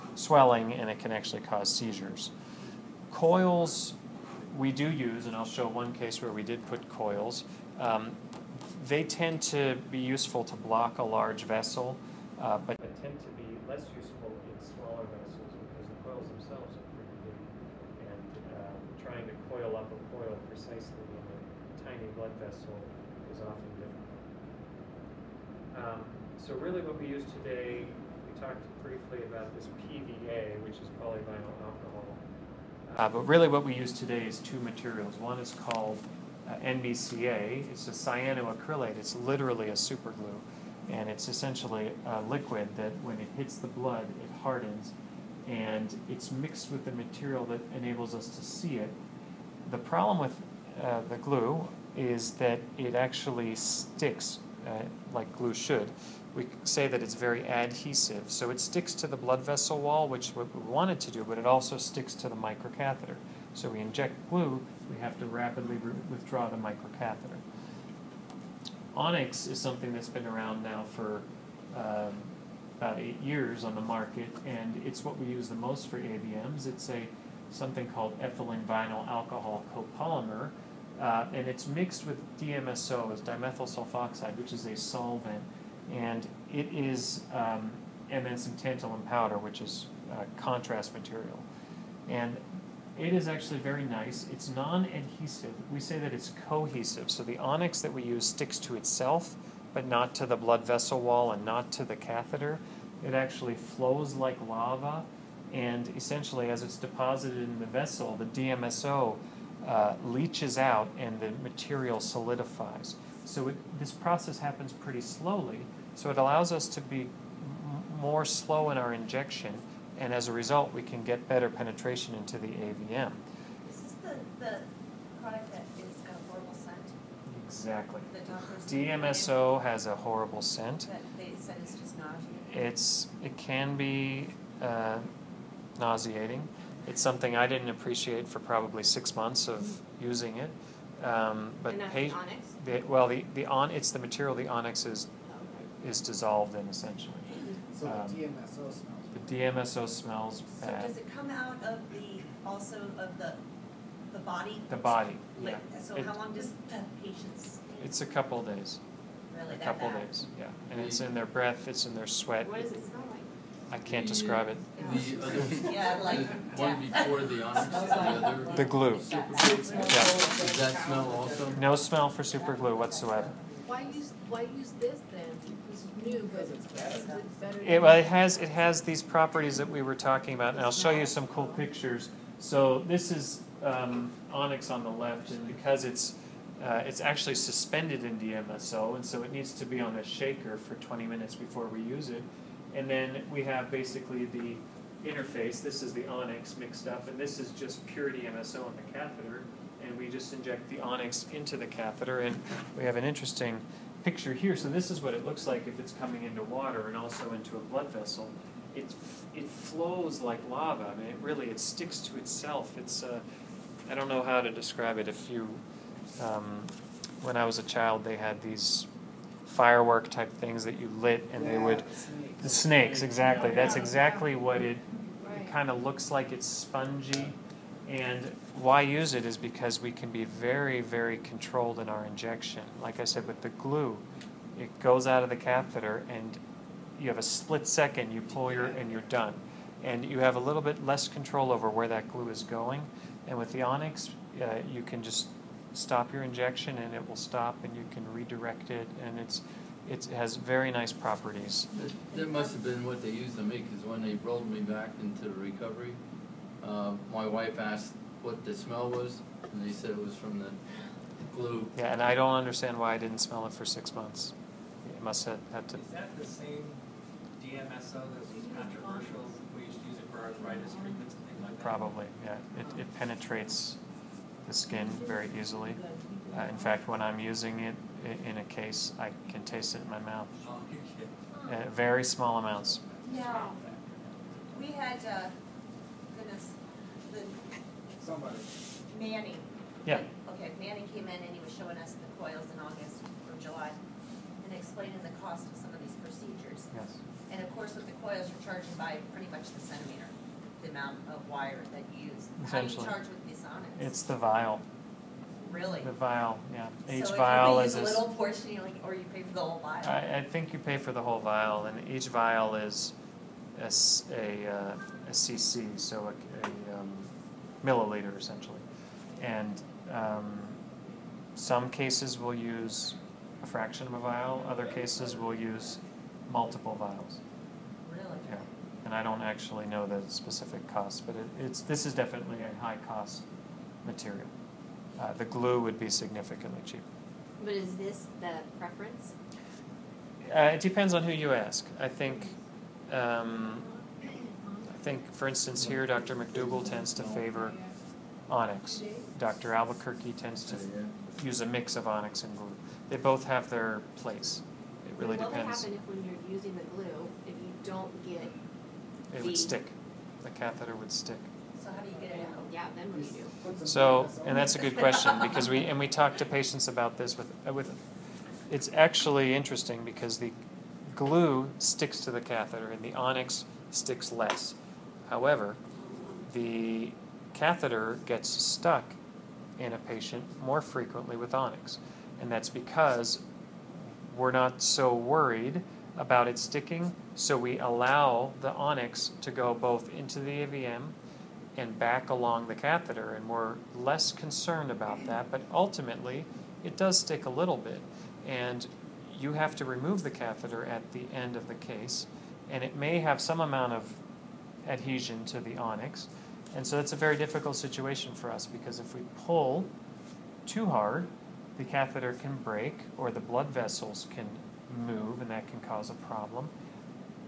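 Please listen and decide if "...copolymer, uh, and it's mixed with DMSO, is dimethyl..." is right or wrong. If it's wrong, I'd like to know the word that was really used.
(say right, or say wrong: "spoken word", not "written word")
right.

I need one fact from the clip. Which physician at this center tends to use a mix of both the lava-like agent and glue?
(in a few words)
Dr. Albuquerque.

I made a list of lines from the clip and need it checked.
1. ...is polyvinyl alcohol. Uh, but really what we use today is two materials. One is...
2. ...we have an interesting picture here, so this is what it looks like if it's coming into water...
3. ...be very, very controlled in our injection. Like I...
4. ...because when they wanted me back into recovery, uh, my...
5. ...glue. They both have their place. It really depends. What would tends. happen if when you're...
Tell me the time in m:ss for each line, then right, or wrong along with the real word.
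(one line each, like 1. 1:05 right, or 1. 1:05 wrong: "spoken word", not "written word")
1. 0:30 right
2. 3:22 right
3. 3:50 right
4. 4:13 wrong: "rolled", not "wanted"
5. 5:52 wrong: "depends", not "tends".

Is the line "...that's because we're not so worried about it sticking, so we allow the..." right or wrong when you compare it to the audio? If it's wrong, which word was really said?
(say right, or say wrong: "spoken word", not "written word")
right.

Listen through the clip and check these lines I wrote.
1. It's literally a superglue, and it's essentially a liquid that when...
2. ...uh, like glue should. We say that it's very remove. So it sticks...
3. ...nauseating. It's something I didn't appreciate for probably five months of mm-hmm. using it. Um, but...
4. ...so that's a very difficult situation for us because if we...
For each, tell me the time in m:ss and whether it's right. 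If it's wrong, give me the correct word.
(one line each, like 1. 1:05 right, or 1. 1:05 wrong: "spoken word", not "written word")
1. 0:38 right
2. 0:54 wrong: "adhesive", not "remove"
3. 2:15 wrong: "six", not "five"
4. 6:46 right.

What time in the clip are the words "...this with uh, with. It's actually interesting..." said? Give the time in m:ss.
6:06.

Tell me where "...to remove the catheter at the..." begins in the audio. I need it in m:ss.
6:39.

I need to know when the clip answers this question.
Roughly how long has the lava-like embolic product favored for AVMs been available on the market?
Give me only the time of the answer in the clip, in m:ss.
1:12.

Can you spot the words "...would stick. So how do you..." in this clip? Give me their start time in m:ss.
6:00.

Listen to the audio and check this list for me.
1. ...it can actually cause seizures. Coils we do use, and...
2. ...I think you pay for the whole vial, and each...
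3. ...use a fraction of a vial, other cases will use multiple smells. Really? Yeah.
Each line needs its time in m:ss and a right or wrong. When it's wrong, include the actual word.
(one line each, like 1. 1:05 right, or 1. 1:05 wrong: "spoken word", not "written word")
1. 0:00 right
2. 5:10 right
3. 5:22 wrong: "vials", not "smells".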